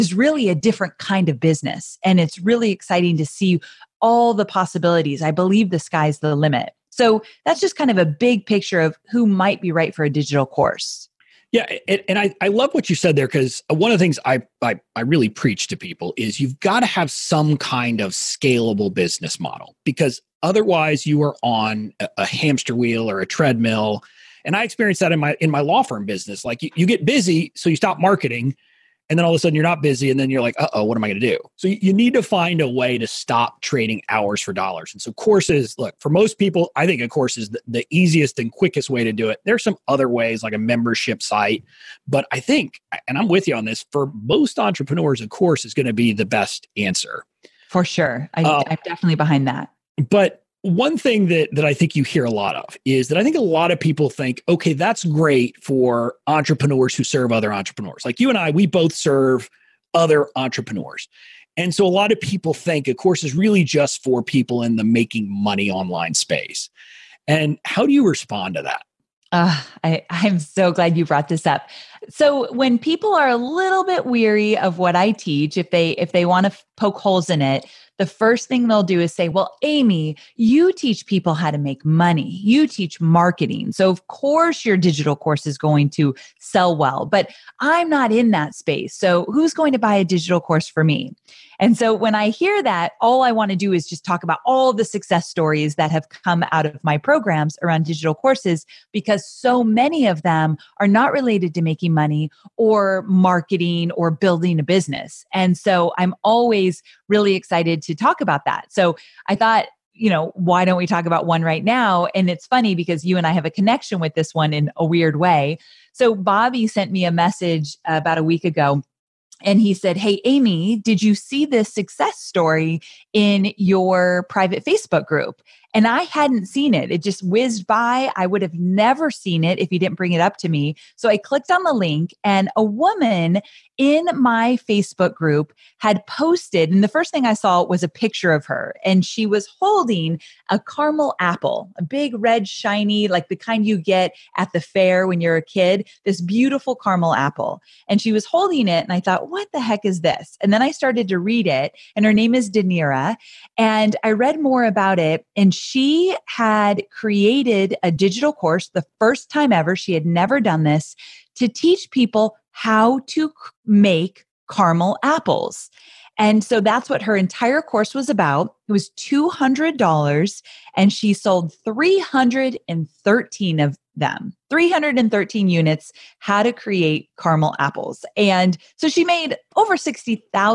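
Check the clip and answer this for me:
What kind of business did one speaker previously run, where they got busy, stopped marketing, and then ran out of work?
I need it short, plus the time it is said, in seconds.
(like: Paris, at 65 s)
Law firm, at 25 s.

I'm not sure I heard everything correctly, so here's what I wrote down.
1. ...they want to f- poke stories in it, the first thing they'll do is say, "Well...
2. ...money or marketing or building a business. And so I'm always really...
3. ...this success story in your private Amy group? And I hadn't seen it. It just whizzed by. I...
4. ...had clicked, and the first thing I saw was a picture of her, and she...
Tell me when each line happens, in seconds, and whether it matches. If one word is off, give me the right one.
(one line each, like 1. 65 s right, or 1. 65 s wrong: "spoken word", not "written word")
1. 76 s wrong: "holes", not "stories"
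2. 101 s right
3. 121 s wrong: "Facebook", not "Amy"
4. 135 s wrong: "posted", not "clicked".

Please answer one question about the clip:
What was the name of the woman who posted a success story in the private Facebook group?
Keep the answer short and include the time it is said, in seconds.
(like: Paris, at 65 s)
Danira, at 152 s.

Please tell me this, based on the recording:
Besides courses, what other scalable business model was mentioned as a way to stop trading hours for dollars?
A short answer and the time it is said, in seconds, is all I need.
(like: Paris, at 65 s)
Membership site, at 40 s.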